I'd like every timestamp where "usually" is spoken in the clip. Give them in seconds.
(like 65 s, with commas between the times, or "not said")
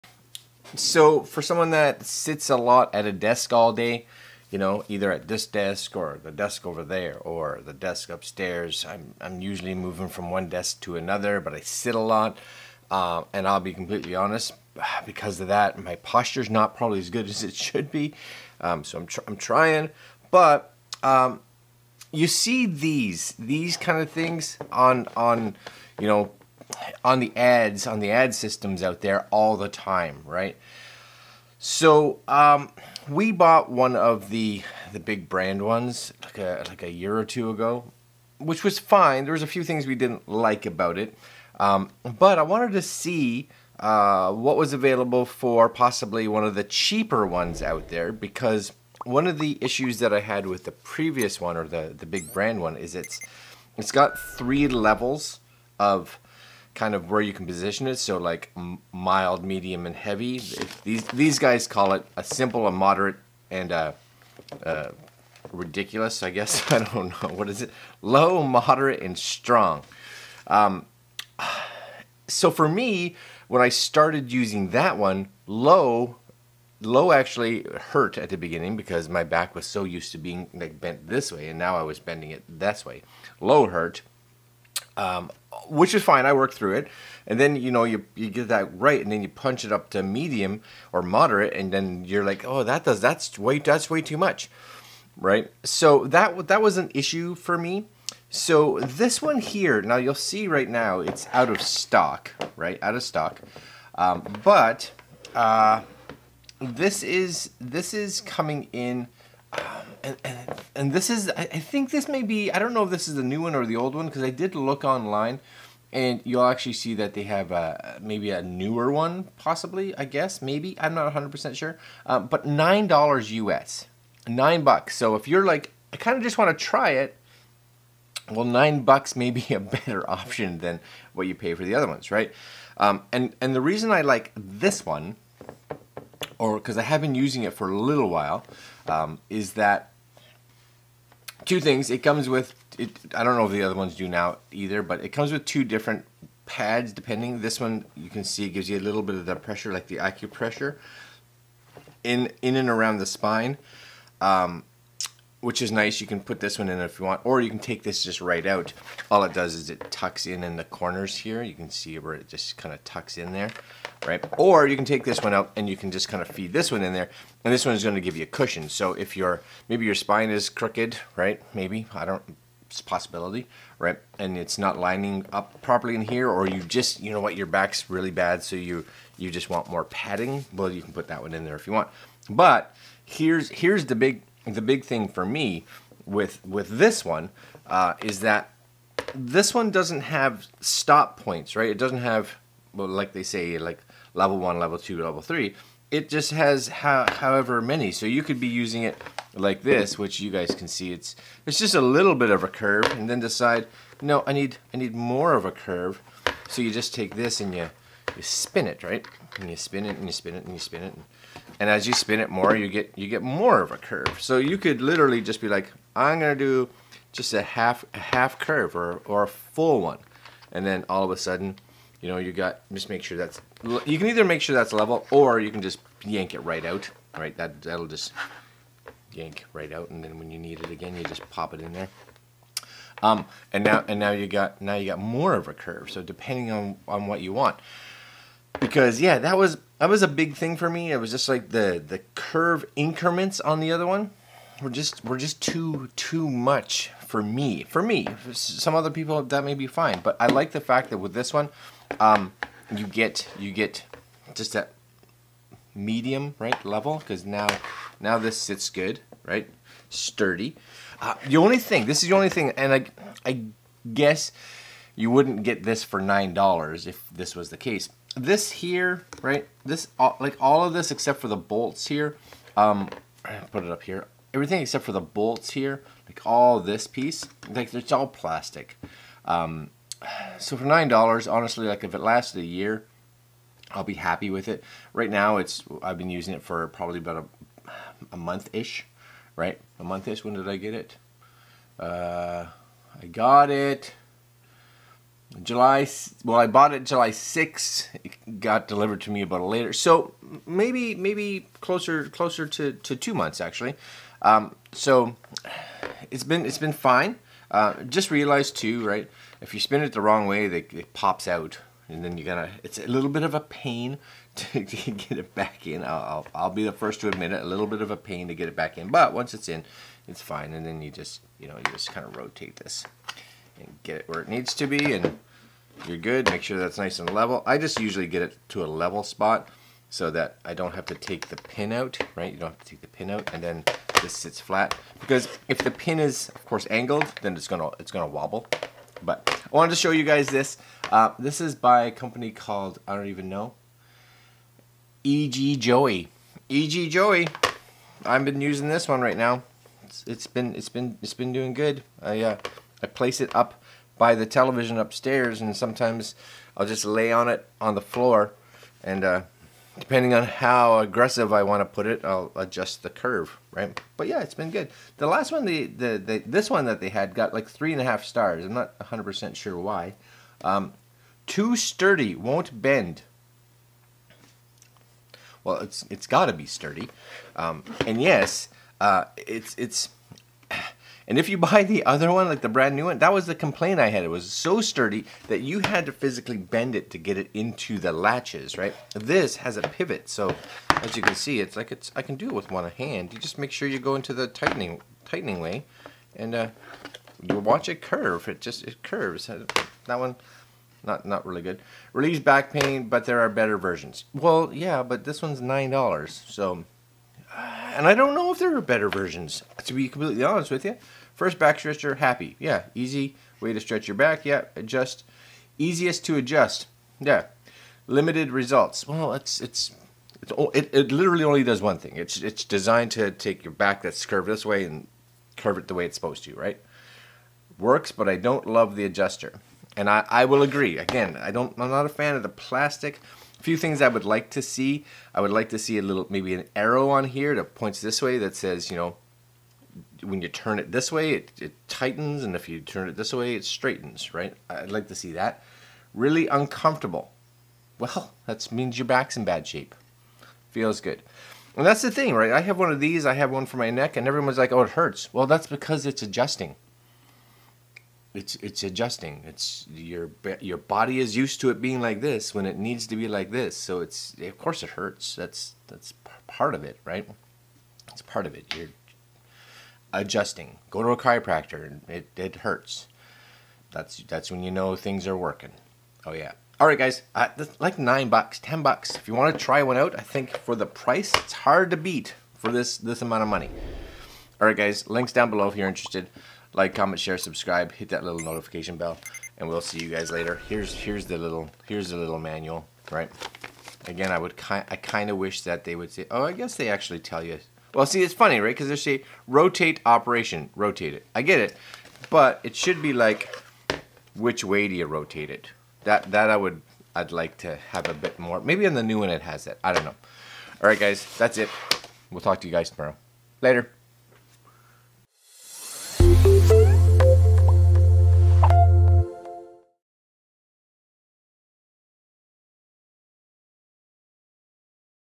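9 s, 327 s.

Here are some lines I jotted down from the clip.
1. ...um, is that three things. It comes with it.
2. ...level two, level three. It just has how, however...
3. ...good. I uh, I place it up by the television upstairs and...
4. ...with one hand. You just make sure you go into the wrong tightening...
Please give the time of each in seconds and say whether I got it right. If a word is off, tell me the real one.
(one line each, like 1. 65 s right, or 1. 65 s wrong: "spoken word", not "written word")
1. 138 s wrong: "two", not "three"
2. 194 s right
3. 351 s right
4. 392 s wrong: "tightening", not "wrong".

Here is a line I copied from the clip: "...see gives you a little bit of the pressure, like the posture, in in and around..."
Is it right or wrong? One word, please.
wrong.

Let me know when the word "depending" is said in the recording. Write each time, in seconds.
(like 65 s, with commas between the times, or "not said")
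146 s, 236 s, 359 s.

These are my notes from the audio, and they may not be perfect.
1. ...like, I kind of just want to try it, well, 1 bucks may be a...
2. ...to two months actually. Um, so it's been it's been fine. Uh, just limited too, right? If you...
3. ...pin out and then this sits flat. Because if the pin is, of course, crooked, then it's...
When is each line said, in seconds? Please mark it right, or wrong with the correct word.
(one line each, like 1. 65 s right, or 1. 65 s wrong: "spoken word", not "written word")
1. 125 s wrong: "9", not "1"
2. 302 s wrong: "realized", not "limited"
3. 332 s wrong: "angled", not "crooked".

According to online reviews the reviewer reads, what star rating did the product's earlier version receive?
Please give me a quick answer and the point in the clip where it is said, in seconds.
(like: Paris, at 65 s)
3.5 stars, at 367 s.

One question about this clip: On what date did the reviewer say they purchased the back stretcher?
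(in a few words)
July 6th.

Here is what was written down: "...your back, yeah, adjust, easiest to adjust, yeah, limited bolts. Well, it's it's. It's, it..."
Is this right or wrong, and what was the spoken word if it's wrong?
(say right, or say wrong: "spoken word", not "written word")
wrong: "results", not "bolts".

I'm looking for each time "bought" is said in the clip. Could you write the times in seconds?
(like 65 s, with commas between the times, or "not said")
33 s, 296 s.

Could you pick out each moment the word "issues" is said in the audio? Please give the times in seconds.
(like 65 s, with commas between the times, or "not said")
49 s, 96 s.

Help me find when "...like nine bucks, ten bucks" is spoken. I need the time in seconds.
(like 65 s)
477 s.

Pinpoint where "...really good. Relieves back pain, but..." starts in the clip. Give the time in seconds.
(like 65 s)
401 s.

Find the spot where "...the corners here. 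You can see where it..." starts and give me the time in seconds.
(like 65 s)
160 s.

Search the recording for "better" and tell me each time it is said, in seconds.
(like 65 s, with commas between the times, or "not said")
129 s, 403 s, 408 s.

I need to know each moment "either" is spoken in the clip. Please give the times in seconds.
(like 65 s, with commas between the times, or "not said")
4 s, 144 s, 224 s.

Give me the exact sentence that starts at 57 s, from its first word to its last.
So like mild, medium, and heavy.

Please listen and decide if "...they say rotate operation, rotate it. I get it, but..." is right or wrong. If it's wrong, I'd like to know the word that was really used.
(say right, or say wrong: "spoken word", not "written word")
right.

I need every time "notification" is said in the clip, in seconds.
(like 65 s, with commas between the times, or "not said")
488 s.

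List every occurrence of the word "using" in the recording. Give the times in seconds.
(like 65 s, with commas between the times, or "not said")
74 s, 137 s, 198 s, 286 s, 348 s.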